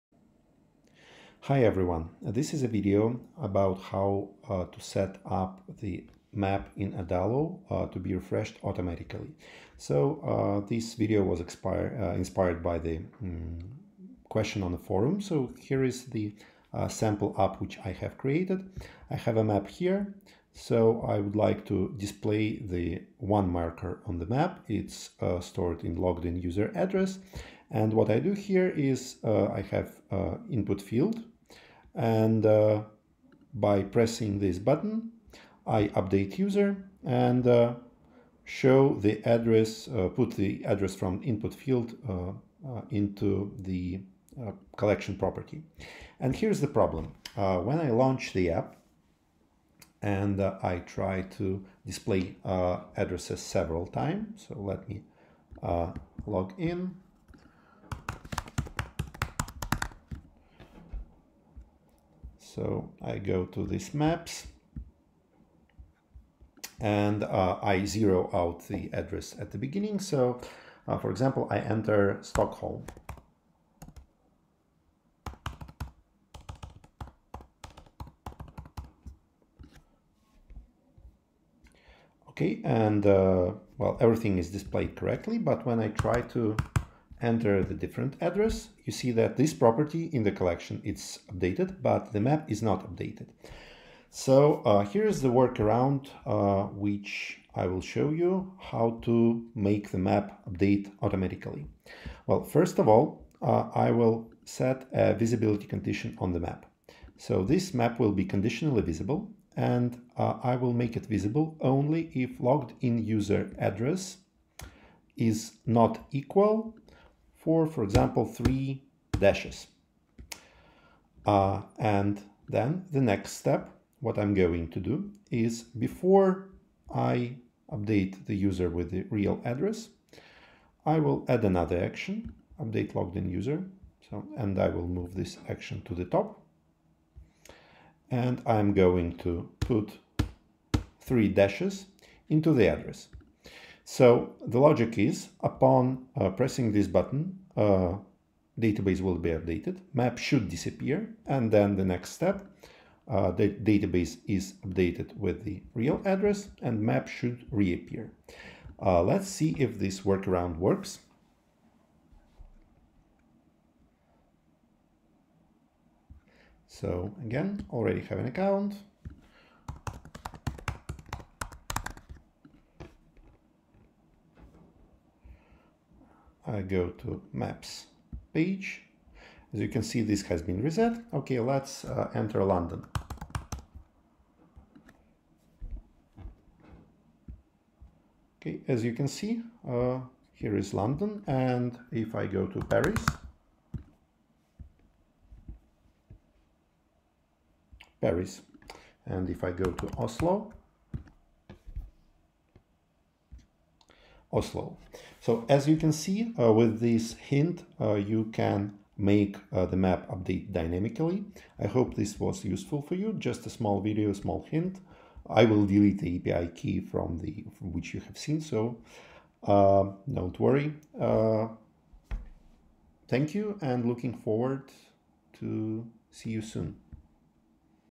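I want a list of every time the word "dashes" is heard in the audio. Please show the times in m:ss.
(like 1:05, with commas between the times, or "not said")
1:59, 2:21.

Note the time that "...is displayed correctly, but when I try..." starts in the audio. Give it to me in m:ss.
1:24.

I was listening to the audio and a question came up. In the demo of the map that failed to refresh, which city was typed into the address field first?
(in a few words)
Stockholm.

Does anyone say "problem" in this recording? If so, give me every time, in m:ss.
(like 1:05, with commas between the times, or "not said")
0:46.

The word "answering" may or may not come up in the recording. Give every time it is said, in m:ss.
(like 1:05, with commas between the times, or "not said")
not said.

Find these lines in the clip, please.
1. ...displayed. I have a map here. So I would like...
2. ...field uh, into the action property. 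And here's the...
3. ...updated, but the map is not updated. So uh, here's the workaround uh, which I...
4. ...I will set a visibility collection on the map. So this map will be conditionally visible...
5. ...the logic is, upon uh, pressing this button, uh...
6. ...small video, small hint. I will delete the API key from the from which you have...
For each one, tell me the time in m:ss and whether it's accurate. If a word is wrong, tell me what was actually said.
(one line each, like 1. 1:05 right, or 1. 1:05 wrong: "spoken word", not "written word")
1. 0:18 wrong: "created", not "displayed"
2. 0:41 wrong: "collection", not "action"
3. 1:31 right
4. 1:43 wrong: "condition", not "collection"
5. 2:24 right
6. 3:33 right.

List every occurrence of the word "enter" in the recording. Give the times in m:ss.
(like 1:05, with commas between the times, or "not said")
1:11, 1:27, 3:02.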